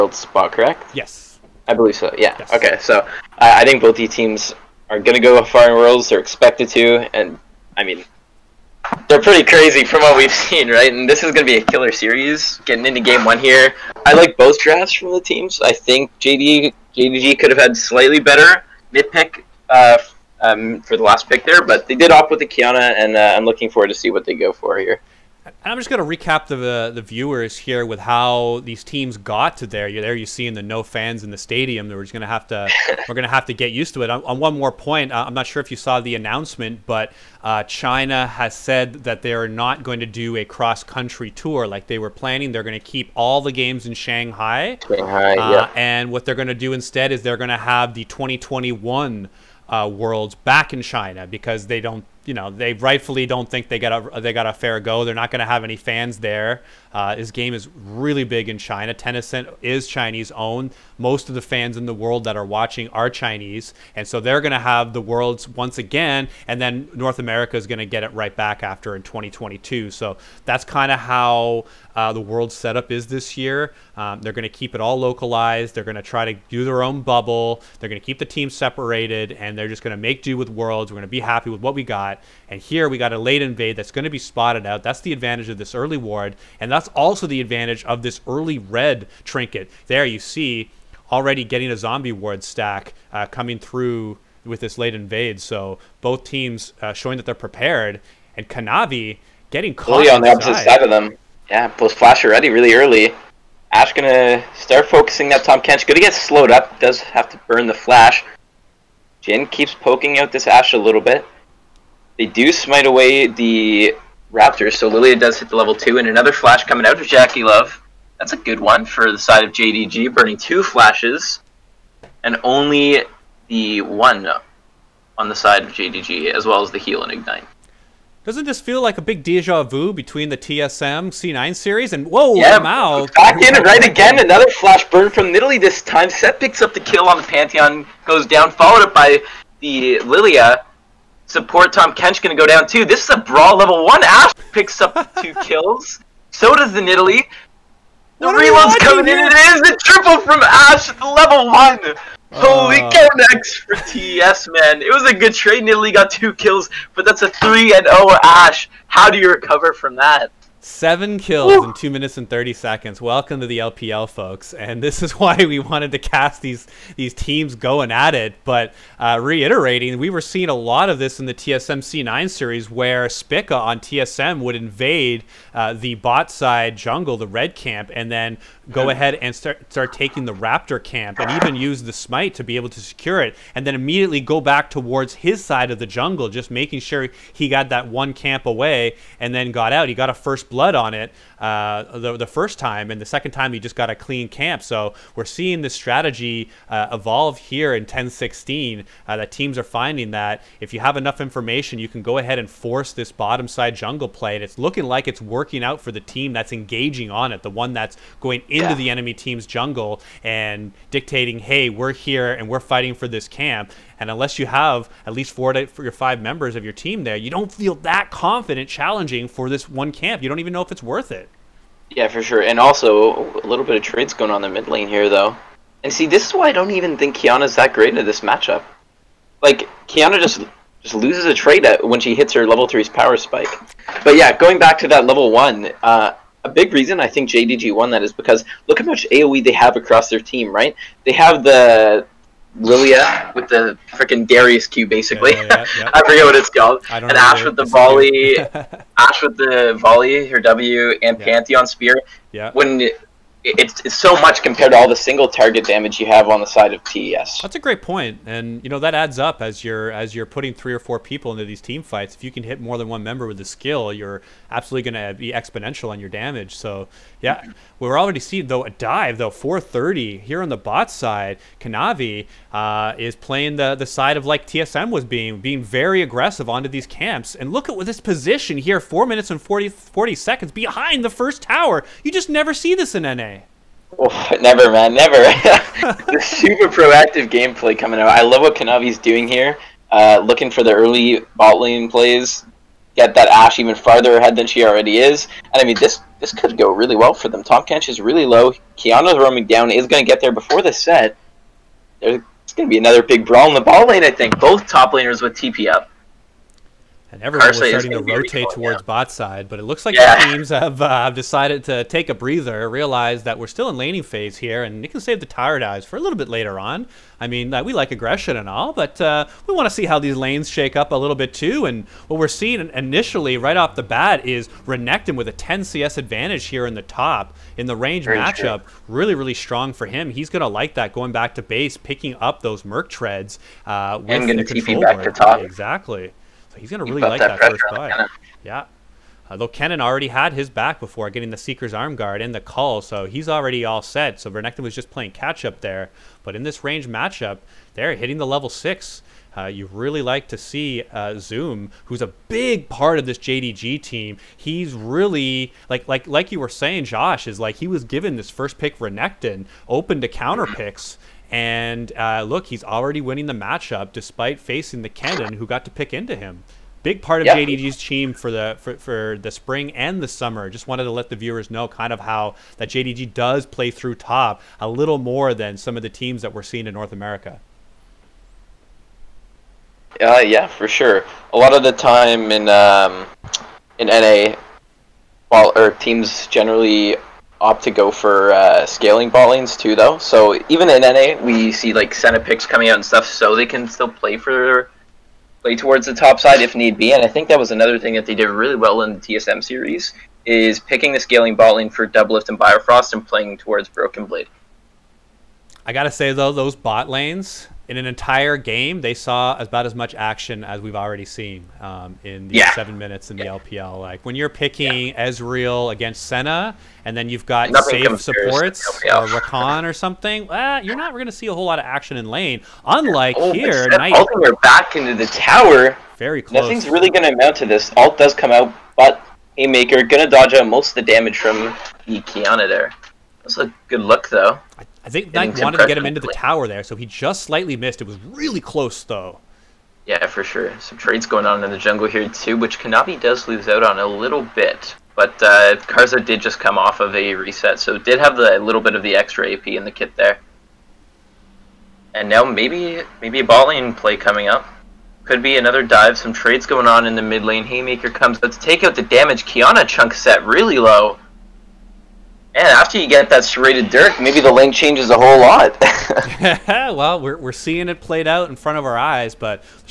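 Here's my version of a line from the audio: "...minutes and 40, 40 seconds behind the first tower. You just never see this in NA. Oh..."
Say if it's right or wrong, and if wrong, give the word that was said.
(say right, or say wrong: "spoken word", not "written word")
right.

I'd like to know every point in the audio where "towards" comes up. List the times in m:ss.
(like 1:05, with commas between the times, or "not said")
3:04, 5:08, 6:35, 6:43.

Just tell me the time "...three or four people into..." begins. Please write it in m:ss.
4:20.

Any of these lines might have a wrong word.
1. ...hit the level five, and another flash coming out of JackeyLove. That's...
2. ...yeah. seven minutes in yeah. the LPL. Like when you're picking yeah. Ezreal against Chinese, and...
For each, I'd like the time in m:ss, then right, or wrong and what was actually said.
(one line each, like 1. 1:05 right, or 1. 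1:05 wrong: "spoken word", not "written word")
1. 1:55 wrong: "two", not "five"
2. 6:52 wrong: "Senna", not "Chinese".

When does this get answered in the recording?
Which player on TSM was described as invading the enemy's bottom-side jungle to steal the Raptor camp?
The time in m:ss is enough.
2:53.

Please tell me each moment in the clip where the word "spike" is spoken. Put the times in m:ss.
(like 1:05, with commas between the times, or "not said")
3:53.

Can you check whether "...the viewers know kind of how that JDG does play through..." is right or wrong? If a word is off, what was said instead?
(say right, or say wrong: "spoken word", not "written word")
right.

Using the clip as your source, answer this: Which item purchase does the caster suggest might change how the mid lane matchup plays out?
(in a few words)
Serrated Dirk.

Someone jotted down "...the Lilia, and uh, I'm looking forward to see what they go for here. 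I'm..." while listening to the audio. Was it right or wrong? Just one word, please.
wrong.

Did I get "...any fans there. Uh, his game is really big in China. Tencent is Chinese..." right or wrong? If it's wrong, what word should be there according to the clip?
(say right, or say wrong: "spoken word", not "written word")
right.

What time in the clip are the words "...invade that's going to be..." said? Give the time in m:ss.
1:23.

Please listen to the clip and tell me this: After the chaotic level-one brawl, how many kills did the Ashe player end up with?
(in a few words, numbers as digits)
3.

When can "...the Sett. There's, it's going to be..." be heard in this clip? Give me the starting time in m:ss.
5:00.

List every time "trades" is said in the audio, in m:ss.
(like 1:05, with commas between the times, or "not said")
2:35, 3:43, 3:51, 7:20, 7:36.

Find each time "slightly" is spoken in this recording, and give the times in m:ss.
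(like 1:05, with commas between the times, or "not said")
0:17, 7:17.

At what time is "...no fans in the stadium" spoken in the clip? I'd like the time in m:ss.
0:30.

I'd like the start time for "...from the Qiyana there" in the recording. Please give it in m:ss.
7:11.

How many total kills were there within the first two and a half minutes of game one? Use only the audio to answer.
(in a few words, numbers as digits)
7.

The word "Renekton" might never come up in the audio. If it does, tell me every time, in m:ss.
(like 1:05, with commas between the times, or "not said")
5:24, 5:44, 5:58.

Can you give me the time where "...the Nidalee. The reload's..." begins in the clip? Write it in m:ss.
2:26.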